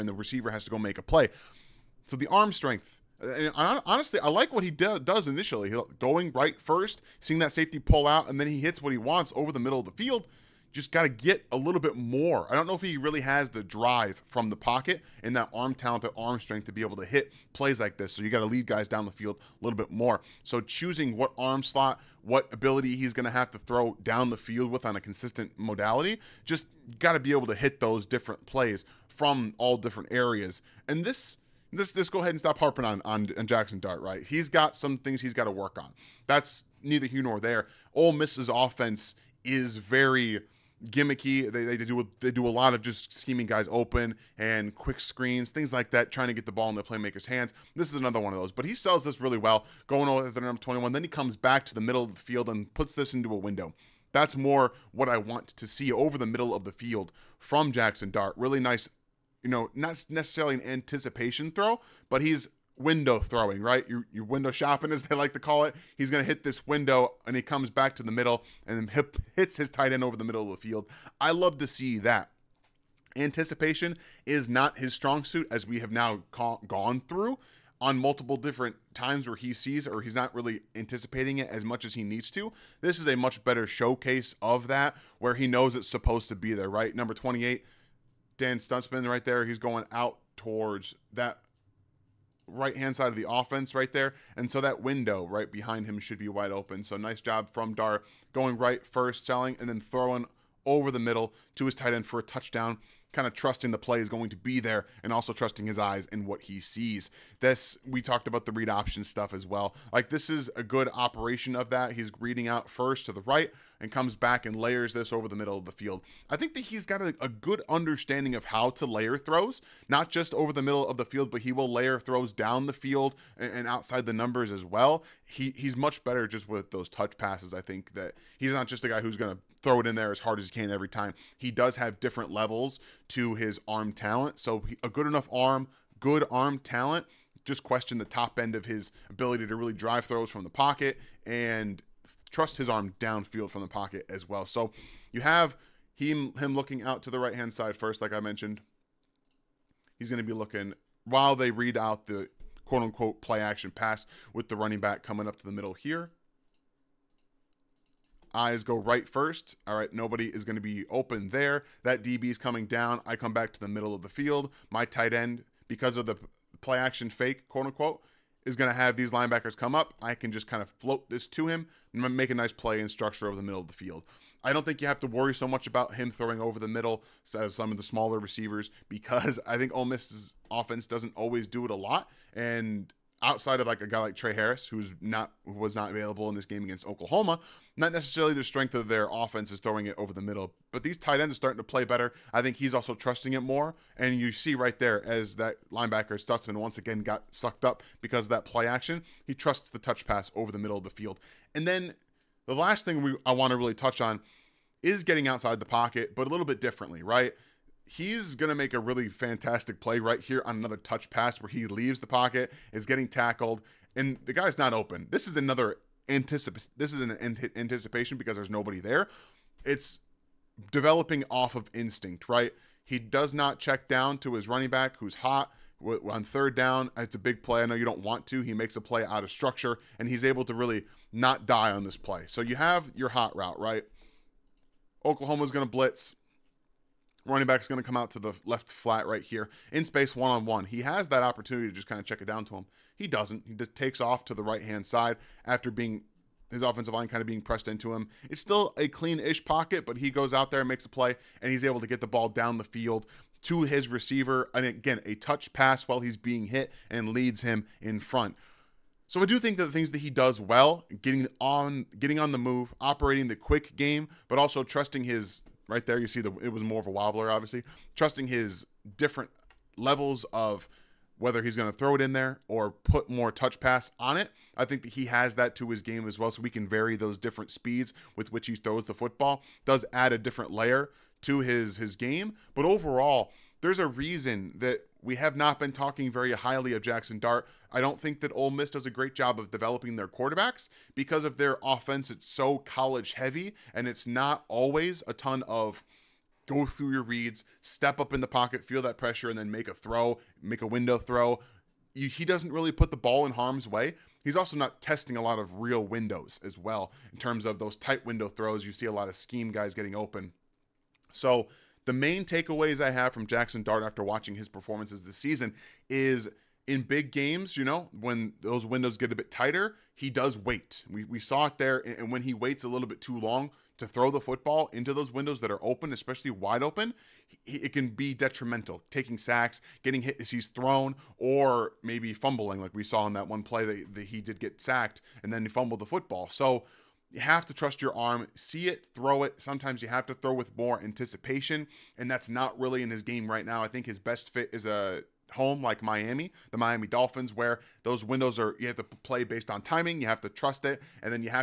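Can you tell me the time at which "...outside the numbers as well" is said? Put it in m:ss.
2:03.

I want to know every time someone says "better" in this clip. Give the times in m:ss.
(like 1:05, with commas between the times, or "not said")
1:23, 2:06, 3:11.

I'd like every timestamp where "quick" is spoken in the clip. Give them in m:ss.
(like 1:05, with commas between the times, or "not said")
0:44, 4:23.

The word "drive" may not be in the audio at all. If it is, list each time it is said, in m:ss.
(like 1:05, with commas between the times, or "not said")
0:13, 2:19.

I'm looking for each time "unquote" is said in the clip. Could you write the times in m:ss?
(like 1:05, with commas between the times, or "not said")
2:32, 2:47.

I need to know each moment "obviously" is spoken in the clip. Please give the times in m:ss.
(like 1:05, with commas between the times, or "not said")
4:27.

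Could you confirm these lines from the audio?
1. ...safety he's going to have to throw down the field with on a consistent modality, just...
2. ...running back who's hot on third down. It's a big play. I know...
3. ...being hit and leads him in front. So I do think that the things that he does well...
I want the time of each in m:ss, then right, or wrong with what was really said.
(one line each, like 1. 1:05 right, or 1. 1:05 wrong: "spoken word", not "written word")
1. 0:22 wrong: "ability", not "safety"
2. 3:44 right
3. 4:16 right.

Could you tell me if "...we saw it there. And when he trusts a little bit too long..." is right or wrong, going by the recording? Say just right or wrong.
wrong.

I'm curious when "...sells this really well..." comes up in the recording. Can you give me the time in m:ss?
0:48.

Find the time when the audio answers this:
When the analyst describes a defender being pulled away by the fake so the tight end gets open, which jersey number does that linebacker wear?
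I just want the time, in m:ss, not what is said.
1:26.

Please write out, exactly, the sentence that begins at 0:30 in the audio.
And this this this go ahead and stop harping on, on on, Jaxson Dart, right?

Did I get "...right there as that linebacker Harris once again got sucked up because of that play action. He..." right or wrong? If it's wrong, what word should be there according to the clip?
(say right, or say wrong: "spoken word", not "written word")
wrong: "Stutsman", not "Harris".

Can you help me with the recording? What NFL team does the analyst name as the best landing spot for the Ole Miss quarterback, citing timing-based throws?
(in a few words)
Miami Dolphins.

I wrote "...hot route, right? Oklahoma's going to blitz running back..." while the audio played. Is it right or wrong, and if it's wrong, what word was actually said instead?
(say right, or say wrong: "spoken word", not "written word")
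right.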